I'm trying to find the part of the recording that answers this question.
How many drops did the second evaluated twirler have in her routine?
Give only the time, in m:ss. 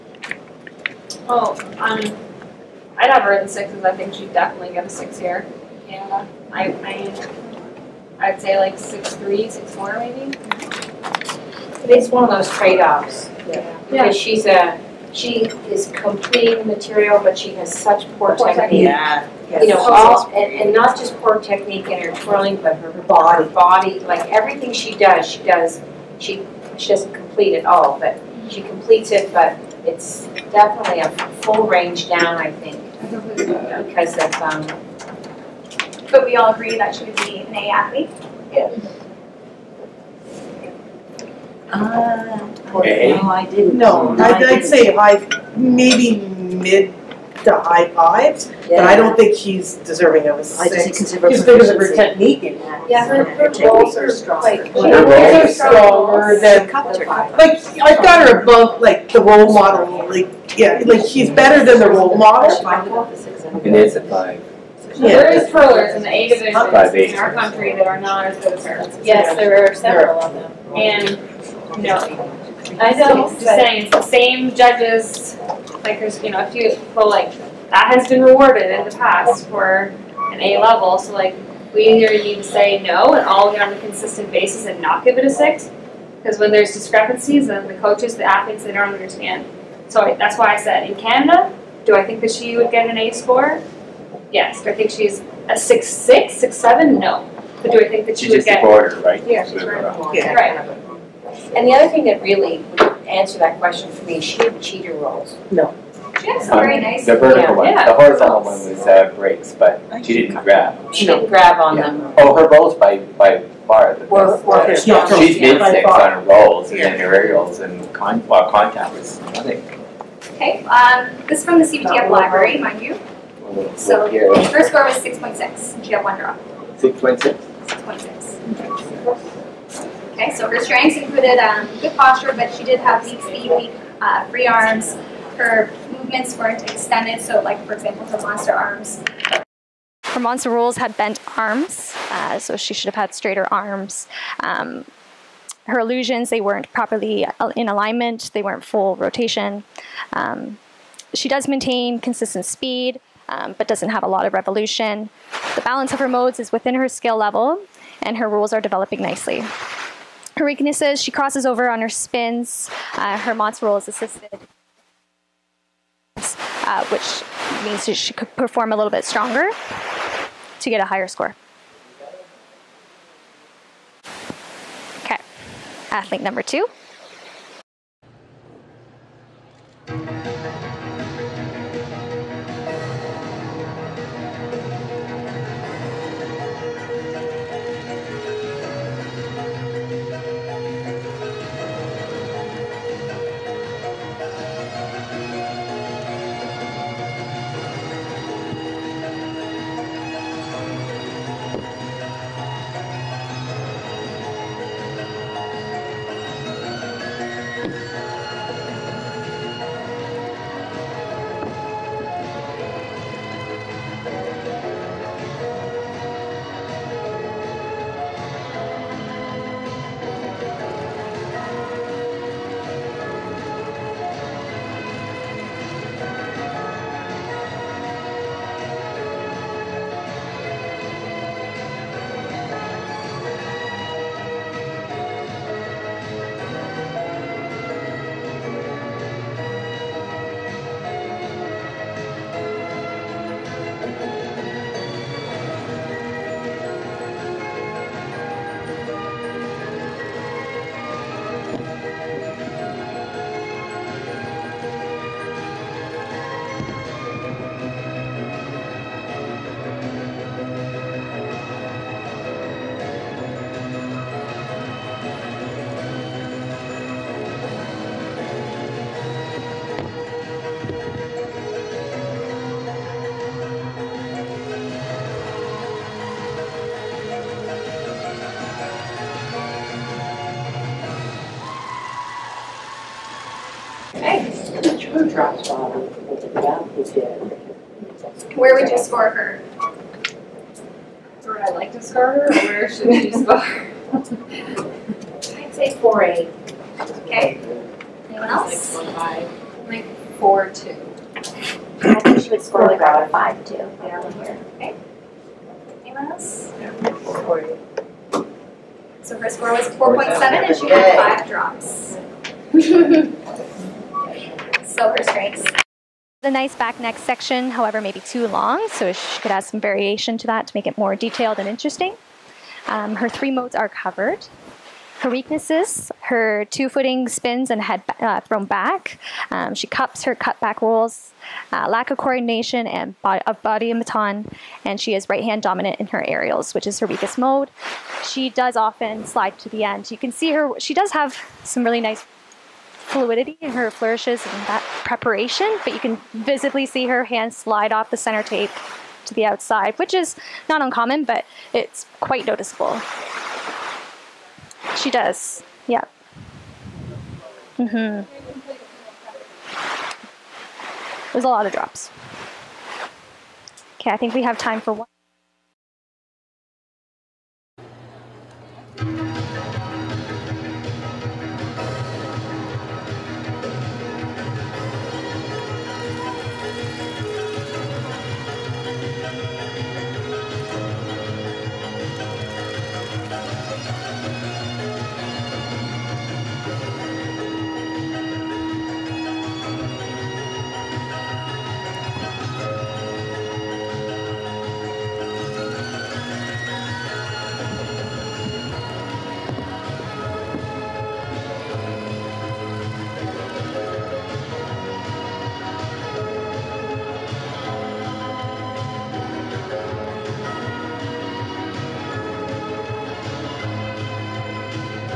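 5:11.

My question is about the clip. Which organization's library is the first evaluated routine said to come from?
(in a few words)
CBTF.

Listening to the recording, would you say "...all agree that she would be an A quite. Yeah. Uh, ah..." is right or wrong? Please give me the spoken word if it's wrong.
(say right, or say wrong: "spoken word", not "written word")
wrong: "athlete", not "quite".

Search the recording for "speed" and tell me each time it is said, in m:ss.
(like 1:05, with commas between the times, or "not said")
2:13, 2:32.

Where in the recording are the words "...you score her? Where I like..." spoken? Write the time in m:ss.
4:48.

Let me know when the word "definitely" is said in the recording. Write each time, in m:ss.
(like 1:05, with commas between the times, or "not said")
0:04, 0:30.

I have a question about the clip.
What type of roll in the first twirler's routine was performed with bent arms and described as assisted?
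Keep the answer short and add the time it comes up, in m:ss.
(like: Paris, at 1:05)
Monster roll, at 2:20.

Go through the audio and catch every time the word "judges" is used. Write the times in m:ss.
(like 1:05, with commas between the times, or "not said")
1:14.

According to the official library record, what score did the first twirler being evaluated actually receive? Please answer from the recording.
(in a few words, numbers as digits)
6.6.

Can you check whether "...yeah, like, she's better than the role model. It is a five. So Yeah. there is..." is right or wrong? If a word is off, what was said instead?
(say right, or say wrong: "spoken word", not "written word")
right.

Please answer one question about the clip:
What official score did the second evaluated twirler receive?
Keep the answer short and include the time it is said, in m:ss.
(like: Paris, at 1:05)
4.7, at 5:09.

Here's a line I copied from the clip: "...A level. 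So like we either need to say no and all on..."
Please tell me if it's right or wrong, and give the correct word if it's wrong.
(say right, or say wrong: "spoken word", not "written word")
right.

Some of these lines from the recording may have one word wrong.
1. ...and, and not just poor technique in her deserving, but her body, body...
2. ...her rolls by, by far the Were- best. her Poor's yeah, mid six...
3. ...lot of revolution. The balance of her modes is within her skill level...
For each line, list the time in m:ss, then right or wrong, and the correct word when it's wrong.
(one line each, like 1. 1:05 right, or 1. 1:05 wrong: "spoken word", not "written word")
1. 0:20 wrong: "twirling", not "deserving"
2. 1:52 wrong: "She", not "Poor"
3. 2:34 right.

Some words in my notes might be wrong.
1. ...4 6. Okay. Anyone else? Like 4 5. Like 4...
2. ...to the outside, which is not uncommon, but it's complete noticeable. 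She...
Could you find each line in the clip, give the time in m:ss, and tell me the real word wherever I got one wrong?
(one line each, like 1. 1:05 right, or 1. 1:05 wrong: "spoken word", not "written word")
1. 4:55 wrong: "8", not "6"
2. 5:49 wrong: "quite", not "complete".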